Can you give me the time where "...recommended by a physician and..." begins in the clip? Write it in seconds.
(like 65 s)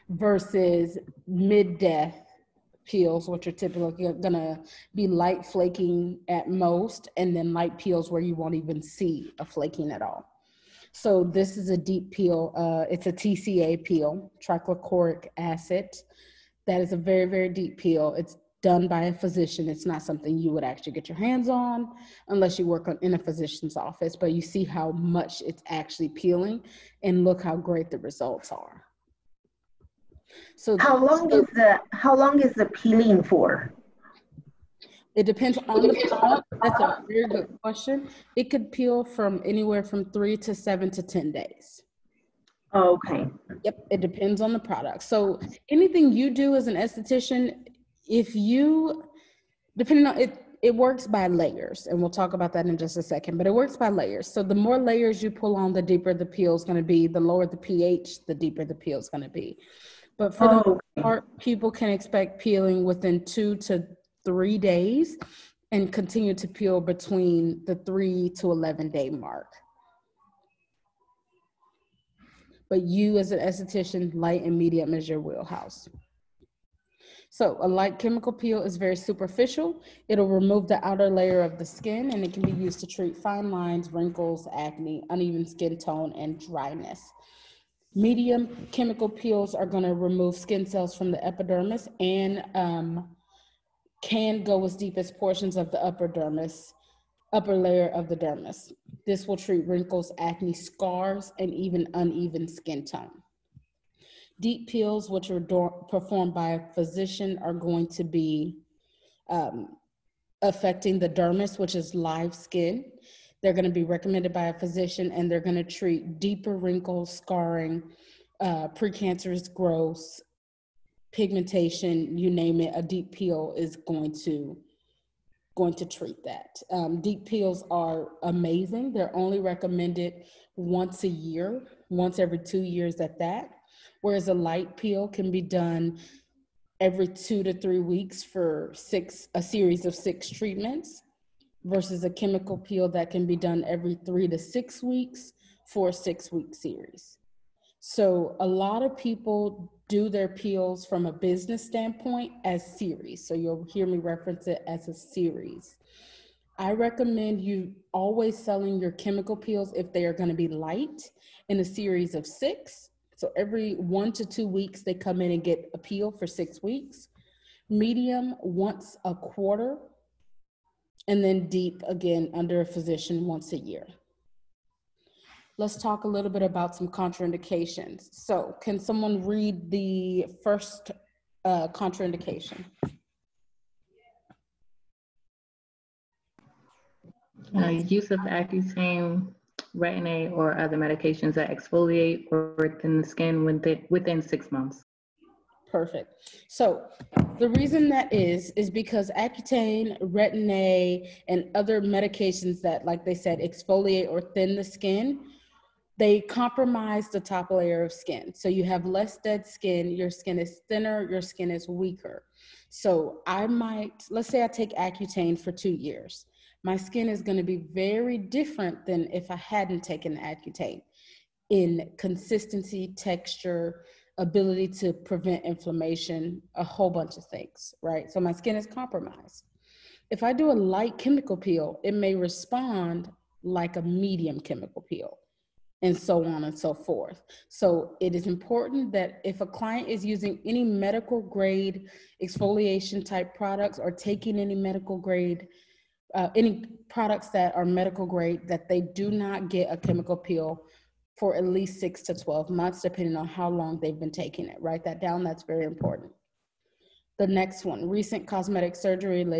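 113 s.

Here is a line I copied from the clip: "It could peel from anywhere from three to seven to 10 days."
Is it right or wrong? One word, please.
right.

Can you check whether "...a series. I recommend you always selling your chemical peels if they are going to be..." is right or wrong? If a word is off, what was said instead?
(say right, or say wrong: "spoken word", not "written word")
right.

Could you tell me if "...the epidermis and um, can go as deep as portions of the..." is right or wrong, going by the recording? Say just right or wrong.
right.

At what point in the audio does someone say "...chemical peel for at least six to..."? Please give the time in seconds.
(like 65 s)
249 s.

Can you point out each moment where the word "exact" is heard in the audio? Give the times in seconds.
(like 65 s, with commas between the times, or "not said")
not said.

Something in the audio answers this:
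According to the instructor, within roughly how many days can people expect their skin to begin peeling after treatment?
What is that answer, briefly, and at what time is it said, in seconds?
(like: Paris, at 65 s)
2 to 3 days, at 63 s.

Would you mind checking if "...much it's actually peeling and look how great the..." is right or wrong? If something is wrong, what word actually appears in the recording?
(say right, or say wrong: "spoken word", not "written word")
right.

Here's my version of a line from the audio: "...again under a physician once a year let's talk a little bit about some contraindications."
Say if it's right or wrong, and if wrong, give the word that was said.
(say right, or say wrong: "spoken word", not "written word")
right.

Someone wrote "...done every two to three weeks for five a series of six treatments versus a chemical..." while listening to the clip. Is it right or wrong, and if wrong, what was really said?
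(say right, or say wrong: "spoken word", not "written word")
wrong: "six", not "five".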